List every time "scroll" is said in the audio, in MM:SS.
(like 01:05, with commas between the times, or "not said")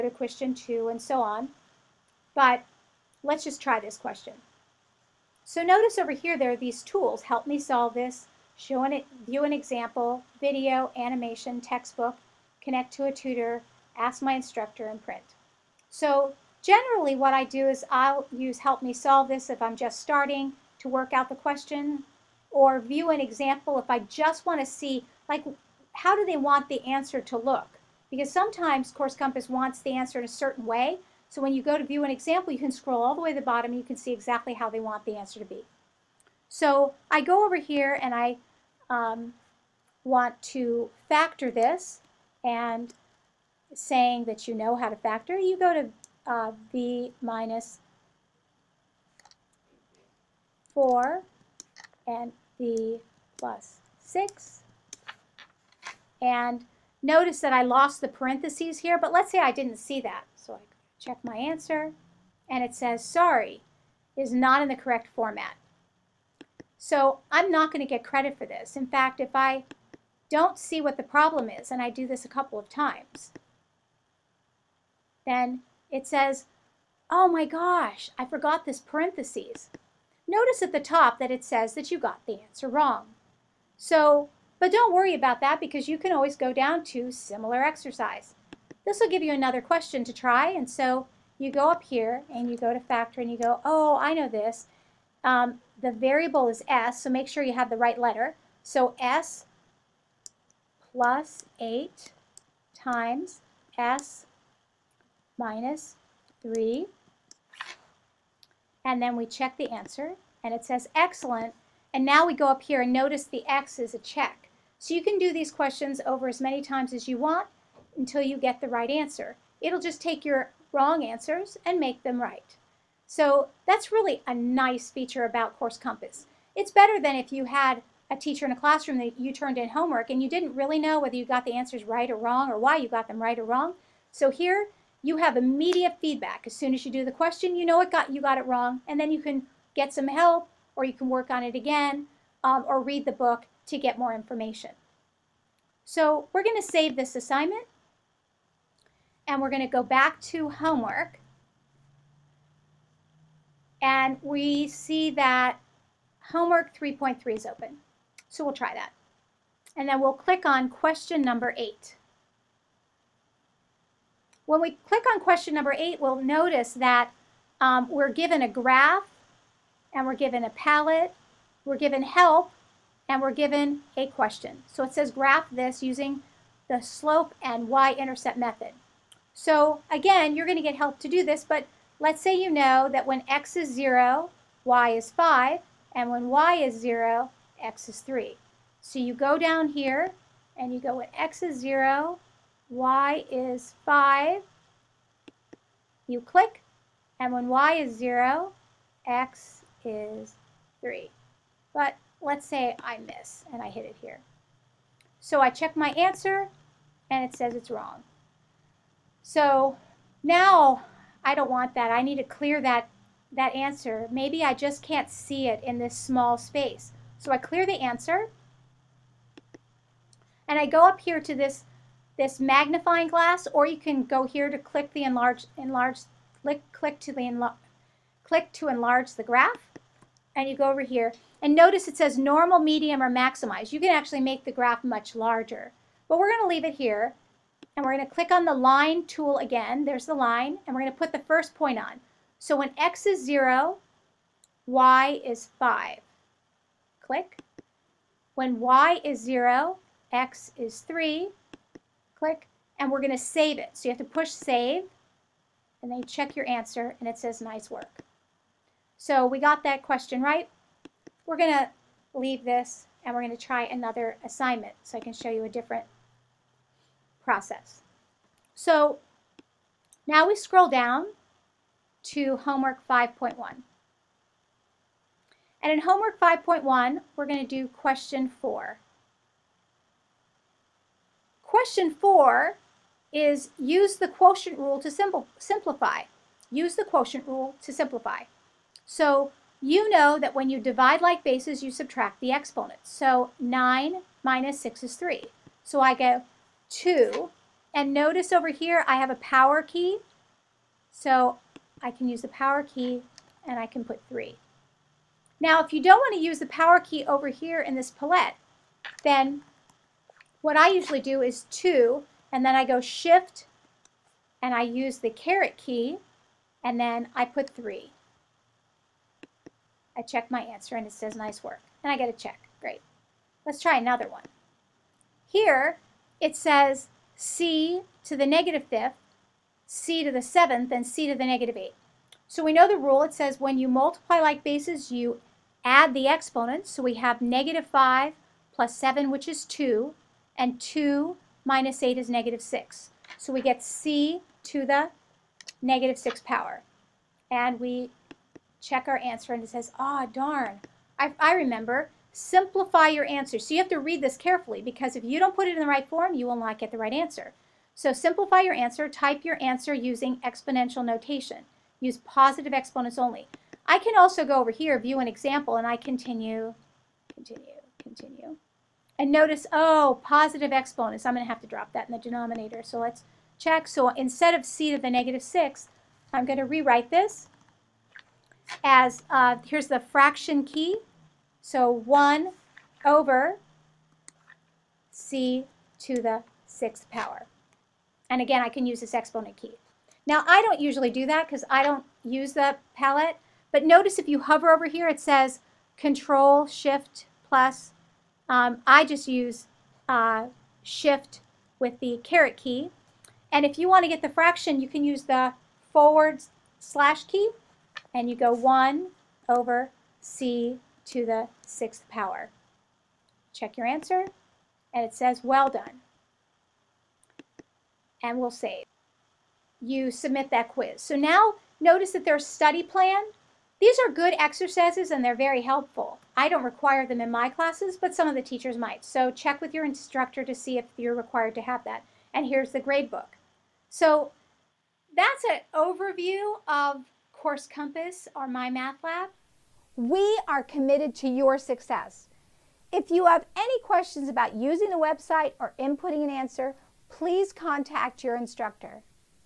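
00:32, 04:30.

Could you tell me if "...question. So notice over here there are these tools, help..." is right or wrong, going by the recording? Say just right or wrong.
right.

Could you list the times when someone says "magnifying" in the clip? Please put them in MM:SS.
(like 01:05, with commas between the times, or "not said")
03:42.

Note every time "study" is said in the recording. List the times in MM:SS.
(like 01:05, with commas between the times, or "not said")
07:02.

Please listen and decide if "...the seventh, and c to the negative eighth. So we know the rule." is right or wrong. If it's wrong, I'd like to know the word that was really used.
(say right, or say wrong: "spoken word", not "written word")
right.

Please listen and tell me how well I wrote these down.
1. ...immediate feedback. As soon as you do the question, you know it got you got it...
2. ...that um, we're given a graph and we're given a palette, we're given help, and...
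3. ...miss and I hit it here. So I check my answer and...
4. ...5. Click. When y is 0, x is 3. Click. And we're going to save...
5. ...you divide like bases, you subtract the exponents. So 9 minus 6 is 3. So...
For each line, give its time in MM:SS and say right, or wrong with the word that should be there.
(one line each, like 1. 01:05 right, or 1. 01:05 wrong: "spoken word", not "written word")
1. 02:15 right
2. 02:46 right
3. 03:22 right
4. 04:05 right
5. 04:50 right.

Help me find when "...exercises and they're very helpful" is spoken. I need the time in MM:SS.
07:04.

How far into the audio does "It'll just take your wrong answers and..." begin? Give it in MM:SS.
01:59.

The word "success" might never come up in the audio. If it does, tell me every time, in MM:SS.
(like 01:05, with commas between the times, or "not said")
07:21.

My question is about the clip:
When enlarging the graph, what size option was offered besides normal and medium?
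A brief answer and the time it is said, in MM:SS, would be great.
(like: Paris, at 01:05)
maximize, at 03:53.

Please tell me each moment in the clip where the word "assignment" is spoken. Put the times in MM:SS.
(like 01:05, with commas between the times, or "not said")
02:27, 04:24.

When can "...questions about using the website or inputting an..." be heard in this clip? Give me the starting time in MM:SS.
07:23.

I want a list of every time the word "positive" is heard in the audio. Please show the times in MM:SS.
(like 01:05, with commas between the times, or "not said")
06:01, 06:10.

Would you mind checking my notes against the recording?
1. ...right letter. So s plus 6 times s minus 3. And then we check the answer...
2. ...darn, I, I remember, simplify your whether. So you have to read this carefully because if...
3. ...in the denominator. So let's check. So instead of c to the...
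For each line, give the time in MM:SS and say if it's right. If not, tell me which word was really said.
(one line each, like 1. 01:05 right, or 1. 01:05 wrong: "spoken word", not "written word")
1. 01:37 wrong: "8", not "6"
2. 05:50 wrong: "answer", not "whether"
3. 06:11 right.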